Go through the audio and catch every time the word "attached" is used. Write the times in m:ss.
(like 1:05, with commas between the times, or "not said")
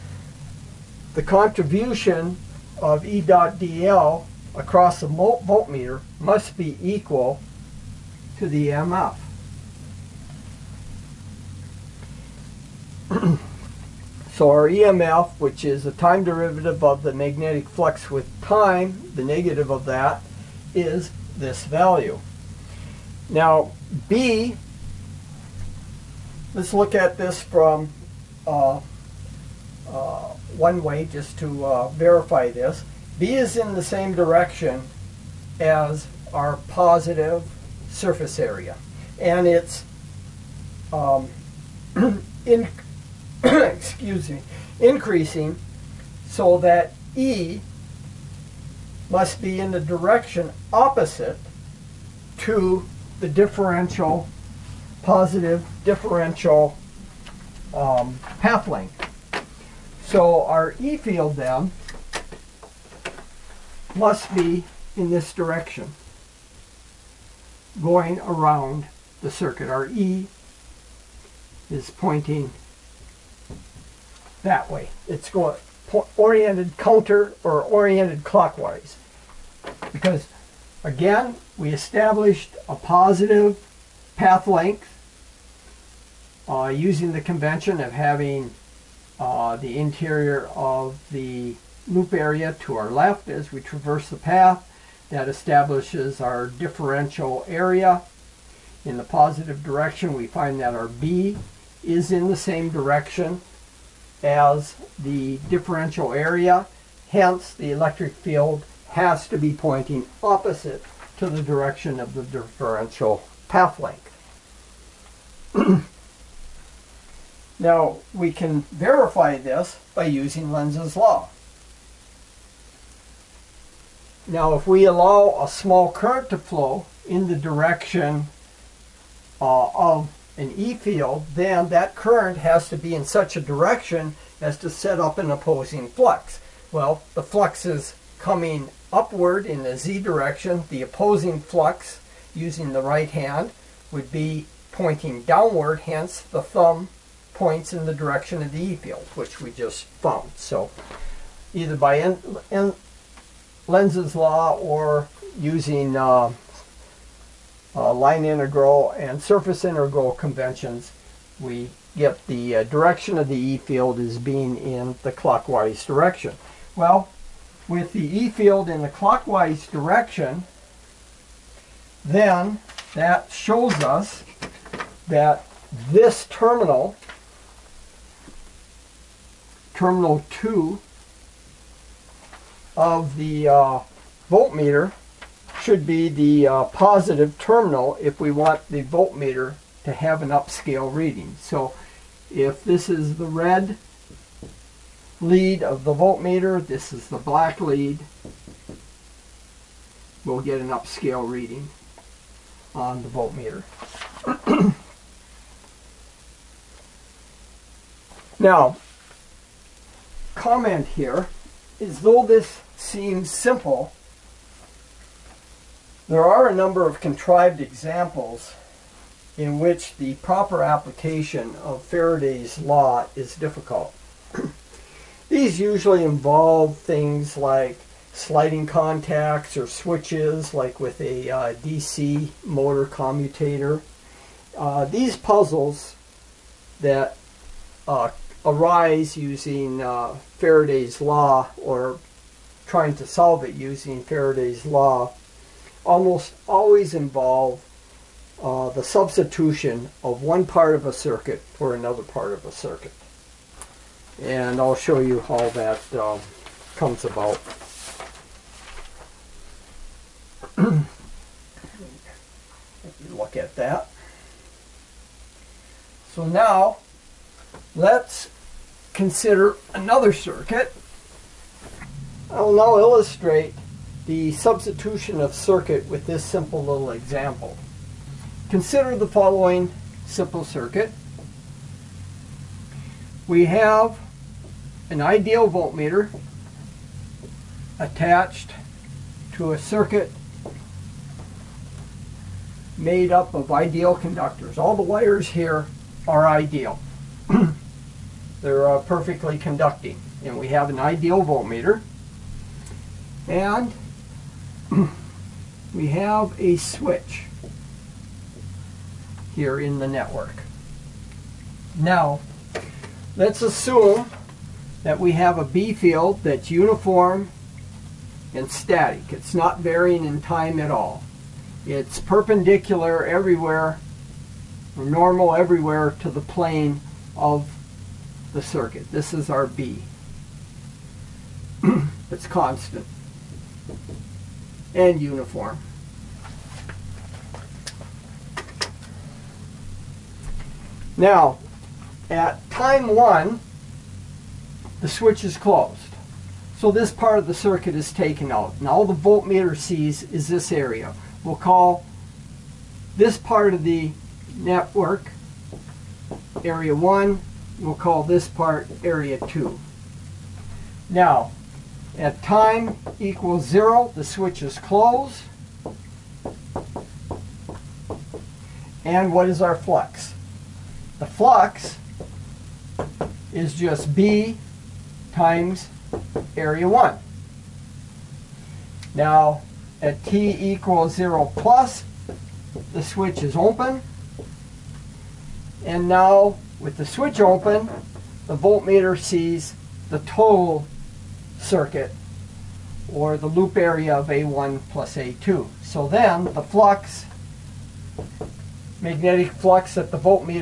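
4:47.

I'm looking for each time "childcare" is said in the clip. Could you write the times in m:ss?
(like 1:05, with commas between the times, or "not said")
not said.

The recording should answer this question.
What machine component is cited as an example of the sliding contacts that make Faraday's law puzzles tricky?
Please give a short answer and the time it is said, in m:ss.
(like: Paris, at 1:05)
DC motor commutator, at 3:51.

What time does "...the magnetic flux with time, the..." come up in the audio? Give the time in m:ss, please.
0:17.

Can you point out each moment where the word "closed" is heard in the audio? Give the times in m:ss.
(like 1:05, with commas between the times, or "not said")
5:45, 6:04.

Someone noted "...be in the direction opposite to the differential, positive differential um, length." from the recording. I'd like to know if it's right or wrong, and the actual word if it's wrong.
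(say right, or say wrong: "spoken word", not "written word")
right.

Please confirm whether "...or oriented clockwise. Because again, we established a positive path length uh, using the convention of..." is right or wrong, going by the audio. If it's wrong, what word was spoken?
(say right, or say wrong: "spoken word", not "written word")
right.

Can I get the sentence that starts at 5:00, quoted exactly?
And we have an ideal voltmeter.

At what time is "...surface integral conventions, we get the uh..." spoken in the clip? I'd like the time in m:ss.
2:39.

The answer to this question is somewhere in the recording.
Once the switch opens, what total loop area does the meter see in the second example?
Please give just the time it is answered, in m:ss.
6:34.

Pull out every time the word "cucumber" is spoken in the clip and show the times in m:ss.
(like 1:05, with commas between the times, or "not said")
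not said.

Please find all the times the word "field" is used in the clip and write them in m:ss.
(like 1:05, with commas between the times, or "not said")
1:00, 1:48, 2:10, 2:28, 2:43, 2:48, 5:15.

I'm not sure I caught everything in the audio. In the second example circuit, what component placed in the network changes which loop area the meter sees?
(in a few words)
a switch.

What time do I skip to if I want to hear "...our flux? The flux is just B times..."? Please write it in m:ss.
6:09.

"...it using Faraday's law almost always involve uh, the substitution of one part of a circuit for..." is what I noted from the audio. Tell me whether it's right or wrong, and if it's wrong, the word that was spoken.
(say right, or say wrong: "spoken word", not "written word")
right.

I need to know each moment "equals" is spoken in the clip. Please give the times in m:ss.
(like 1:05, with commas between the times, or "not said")
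0:06, 6:02, 6:20.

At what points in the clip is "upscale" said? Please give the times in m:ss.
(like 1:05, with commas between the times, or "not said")
3:10, 3:20.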